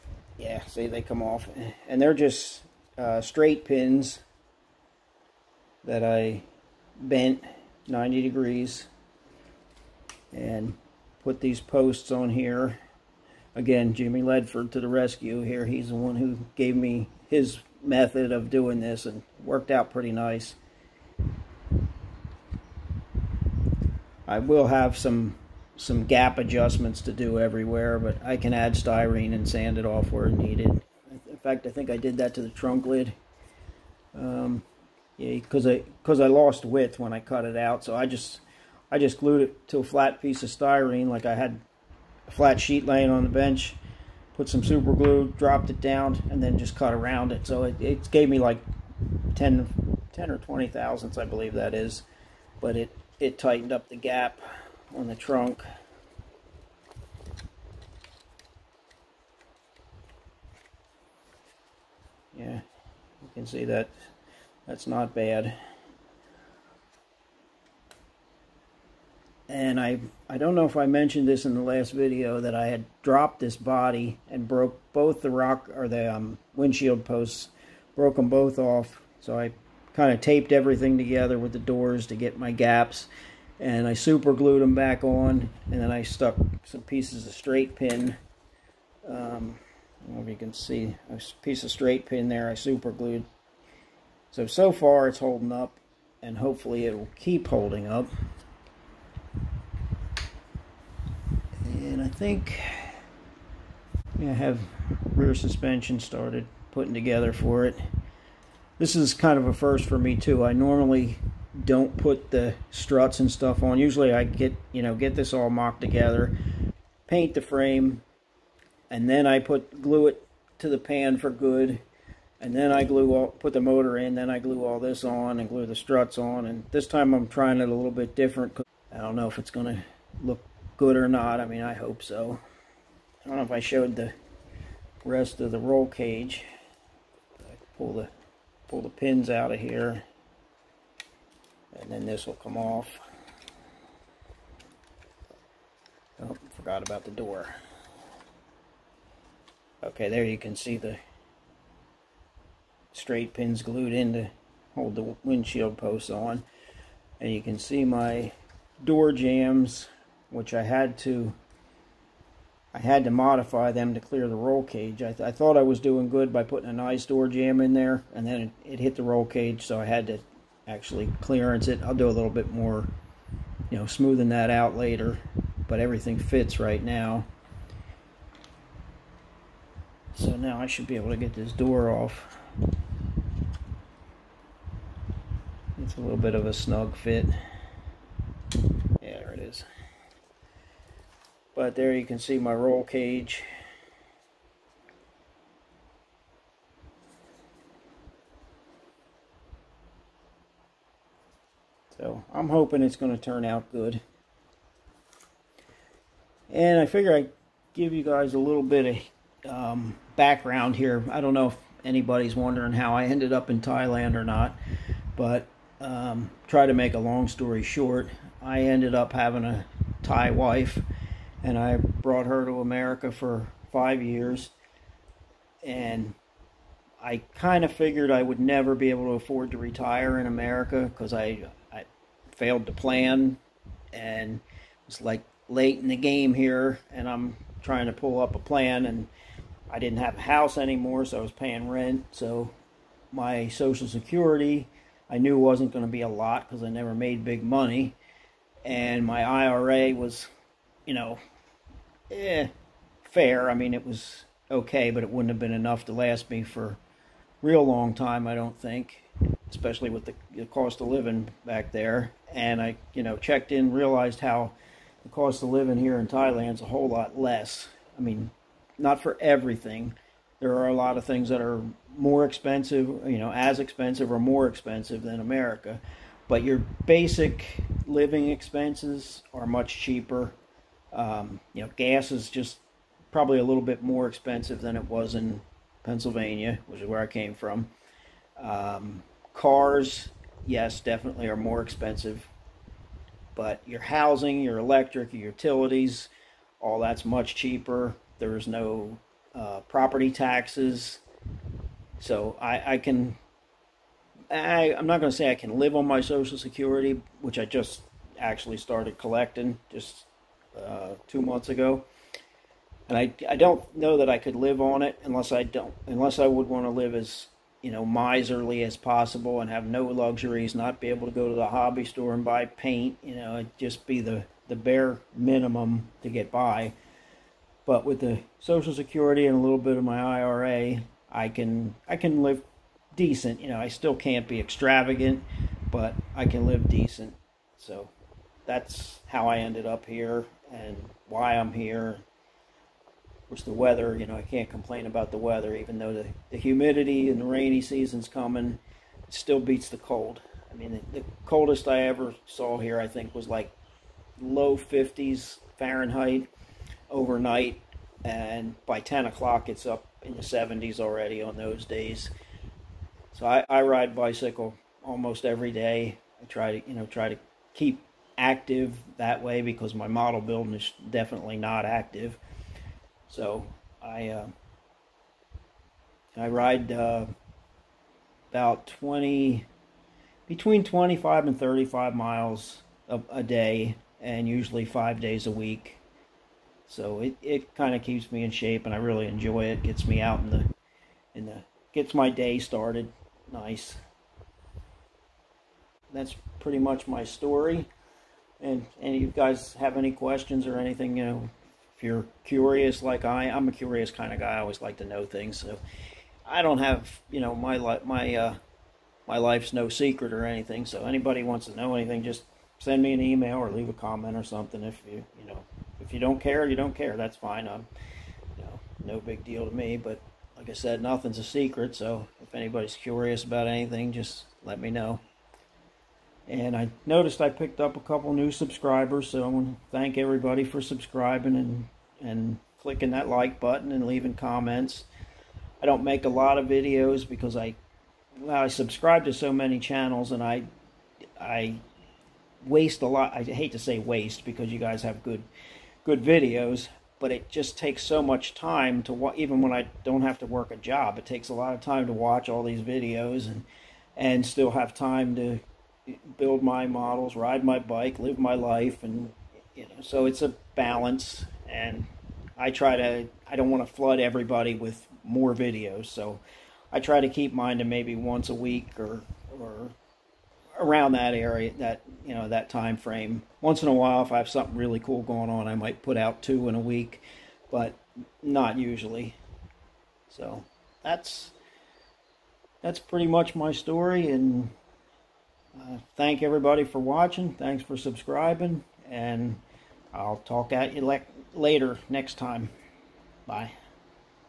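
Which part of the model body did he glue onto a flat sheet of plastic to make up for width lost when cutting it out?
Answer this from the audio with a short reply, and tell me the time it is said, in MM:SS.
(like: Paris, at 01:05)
trunk lid, at 00:32.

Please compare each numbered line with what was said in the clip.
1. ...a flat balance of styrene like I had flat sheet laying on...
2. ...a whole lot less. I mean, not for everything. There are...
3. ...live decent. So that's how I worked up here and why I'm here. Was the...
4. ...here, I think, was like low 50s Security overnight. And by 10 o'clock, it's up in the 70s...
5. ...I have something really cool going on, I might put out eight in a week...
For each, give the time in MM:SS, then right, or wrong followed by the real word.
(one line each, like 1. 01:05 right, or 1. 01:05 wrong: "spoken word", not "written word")
1. 00:39 wrong: "piece", not "balance"
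2. 04:26 right
3. 05:36 wrong: "ended", not "worked"
4. 05:52 wrong: "Fahrenheit", not "Security"
5. 07:54 wrong: "two", not "eight".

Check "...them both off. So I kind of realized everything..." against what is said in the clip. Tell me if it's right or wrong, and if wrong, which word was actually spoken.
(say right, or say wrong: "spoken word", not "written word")
wrong: "taped", not "realized".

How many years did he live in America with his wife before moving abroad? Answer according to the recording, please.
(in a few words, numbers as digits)
5.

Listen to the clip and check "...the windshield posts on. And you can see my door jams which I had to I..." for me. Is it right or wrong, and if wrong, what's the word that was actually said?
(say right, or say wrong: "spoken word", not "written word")
right.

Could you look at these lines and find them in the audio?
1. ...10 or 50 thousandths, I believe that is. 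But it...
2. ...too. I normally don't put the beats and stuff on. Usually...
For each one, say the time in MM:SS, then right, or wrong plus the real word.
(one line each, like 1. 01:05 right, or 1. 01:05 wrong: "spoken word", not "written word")
1. 00:50 wrong: "20", not "50"
2. 01:50 wrong: "struts", not "beats".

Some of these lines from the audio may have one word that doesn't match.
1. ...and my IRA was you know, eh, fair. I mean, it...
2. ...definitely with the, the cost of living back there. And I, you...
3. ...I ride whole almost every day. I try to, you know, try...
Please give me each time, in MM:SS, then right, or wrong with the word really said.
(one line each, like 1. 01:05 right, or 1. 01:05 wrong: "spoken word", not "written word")
1. 04:08 right
2. 04:19 wrong: "especially", not "definitely"
3. 06:03 wrong: "bicycle", not "whole".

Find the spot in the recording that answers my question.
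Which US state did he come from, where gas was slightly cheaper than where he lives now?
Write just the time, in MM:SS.
04:45.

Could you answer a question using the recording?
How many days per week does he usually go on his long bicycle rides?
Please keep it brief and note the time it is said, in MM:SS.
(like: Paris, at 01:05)
5, at 06:24.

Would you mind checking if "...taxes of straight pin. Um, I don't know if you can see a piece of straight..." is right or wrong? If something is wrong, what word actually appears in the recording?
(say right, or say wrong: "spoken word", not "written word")
wrong: "pieces", not "taxes".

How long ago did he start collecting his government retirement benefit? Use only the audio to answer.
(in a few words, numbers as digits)
2 months.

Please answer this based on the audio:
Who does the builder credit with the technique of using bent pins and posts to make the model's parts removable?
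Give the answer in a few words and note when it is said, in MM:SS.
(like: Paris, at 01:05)
Jimmy Ledford, at 00:13.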